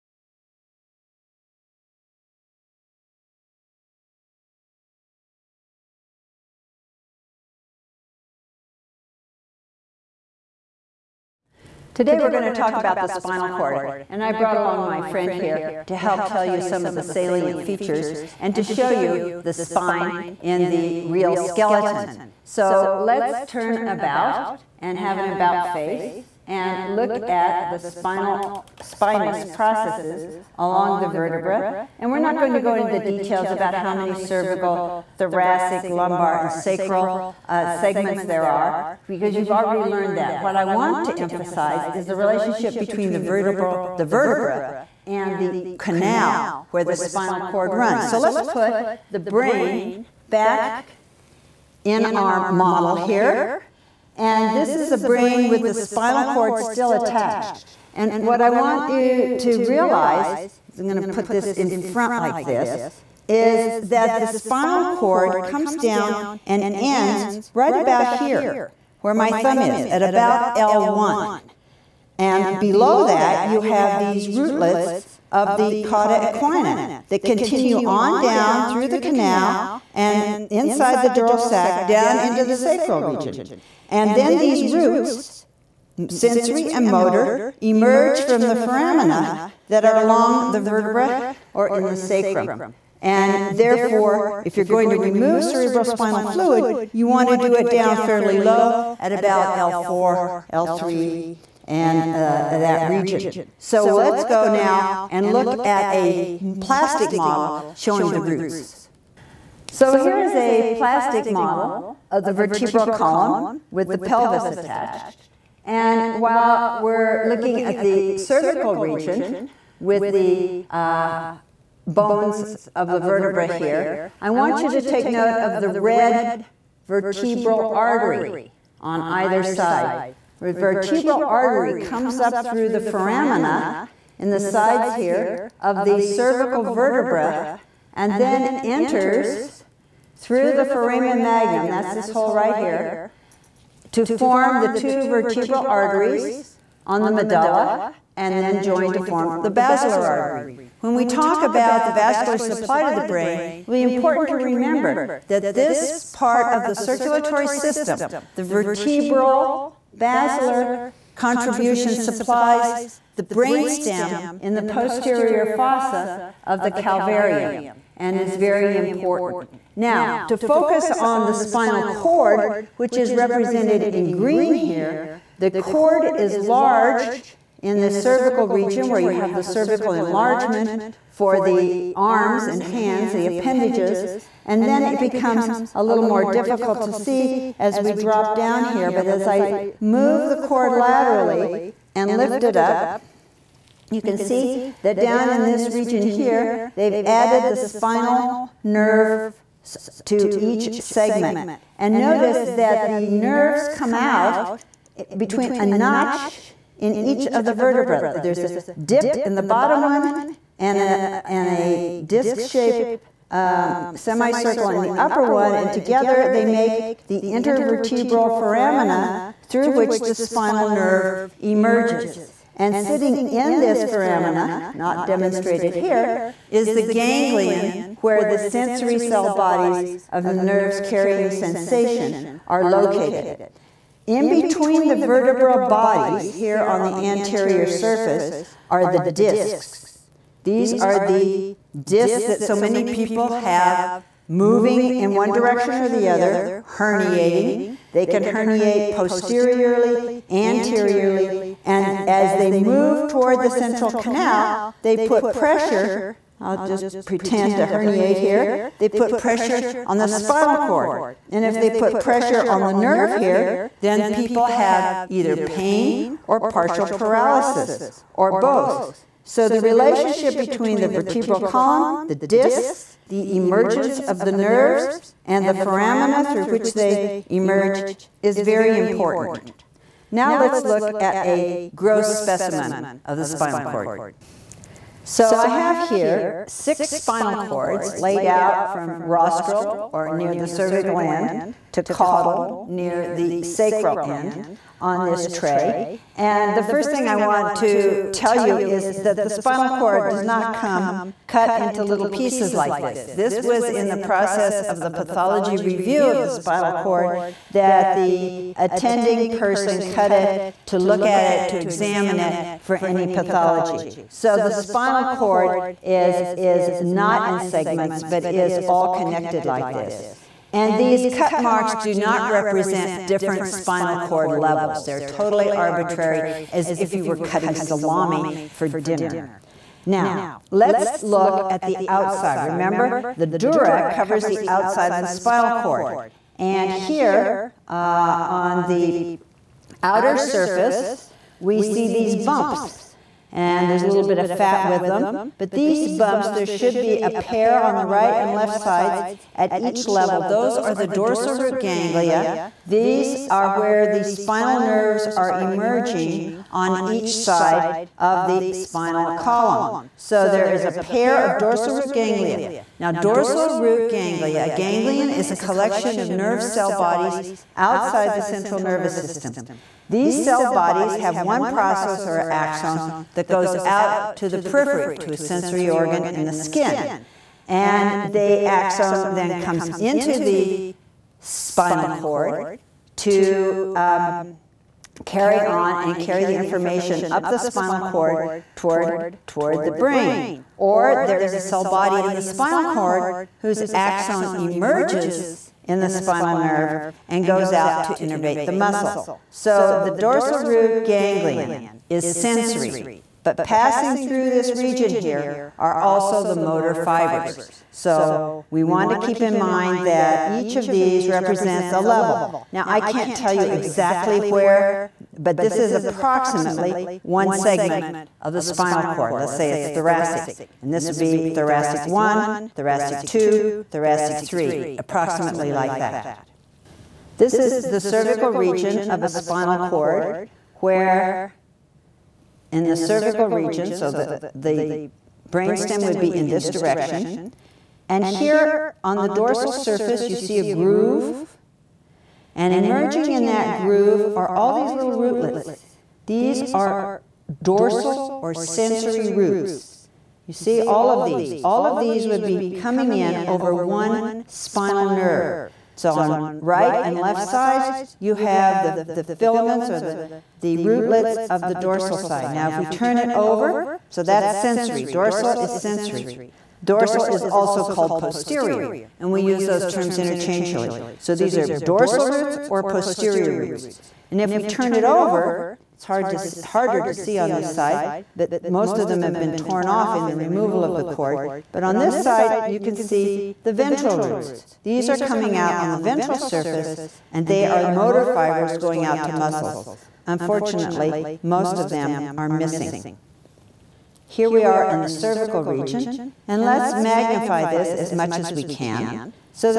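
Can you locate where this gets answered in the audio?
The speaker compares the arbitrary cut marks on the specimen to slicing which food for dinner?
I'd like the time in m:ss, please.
5:27.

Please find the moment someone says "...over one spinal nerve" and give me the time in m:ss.
7:33.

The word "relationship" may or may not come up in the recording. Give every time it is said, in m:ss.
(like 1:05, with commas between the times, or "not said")
0:42, 4:29.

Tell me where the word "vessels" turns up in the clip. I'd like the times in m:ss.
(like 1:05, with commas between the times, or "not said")
not said.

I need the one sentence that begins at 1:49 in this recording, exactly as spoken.
So here is a plastic model of the vertebral column with the pelvis attached.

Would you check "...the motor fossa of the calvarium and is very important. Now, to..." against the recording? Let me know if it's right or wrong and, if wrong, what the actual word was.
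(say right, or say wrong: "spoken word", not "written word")
wrong: "posterior", not "motor".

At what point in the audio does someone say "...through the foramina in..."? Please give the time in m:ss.
2:12.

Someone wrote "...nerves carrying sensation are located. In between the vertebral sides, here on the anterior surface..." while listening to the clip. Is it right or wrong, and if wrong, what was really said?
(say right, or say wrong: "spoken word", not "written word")
wrong: "bodies", not "sides".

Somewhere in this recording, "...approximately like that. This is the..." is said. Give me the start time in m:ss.
7:04.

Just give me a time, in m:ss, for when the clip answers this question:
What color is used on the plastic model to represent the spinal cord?
2:54.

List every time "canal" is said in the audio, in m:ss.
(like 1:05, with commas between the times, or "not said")
0:45, 1:18, 4:13.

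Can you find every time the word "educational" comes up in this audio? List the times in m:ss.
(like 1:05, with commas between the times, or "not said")
not said.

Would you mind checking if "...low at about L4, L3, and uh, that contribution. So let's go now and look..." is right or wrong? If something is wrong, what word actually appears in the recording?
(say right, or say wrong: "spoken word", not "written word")
wrong: "region", not "contribution".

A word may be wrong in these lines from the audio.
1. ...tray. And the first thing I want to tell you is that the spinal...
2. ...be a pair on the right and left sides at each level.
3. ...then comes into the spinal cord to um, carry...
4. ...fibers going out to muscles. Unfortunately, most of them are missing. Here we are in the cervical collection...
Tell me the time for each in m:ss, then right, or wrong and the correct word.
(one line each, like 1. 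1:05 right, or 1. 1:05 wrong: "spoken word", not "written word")
1. 4:55 right
2. 5:46 right
3. 6:19 right
4. 8:08 wrong: "region", not "collection".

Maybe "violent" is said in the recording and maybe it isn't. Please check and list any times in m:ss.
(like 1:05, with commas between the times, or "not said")
not said.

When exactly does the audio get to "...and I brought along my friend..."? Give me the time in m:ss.
0:14.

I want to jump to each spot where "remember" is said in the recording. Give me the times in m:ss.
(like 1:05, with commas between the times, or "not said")
2:34, 5:32.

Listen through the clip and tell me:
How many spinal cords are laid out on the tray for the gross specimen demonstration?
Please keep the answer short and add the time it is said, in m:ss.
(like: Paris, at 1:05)
6, at 4:46.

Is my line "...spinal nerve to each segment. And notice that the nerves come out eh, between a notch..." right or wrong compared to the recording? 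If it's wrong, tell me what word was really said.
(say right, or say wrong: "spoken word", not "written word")
right.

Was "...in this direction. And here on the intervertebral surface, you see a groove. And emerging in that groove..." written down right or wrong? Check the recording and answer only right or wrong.
wrong.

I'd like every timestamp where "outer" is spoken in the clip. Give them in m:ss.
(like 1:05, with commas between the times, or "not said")
5:39.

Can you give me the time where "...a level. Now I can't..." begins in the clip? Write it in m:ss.
6:51.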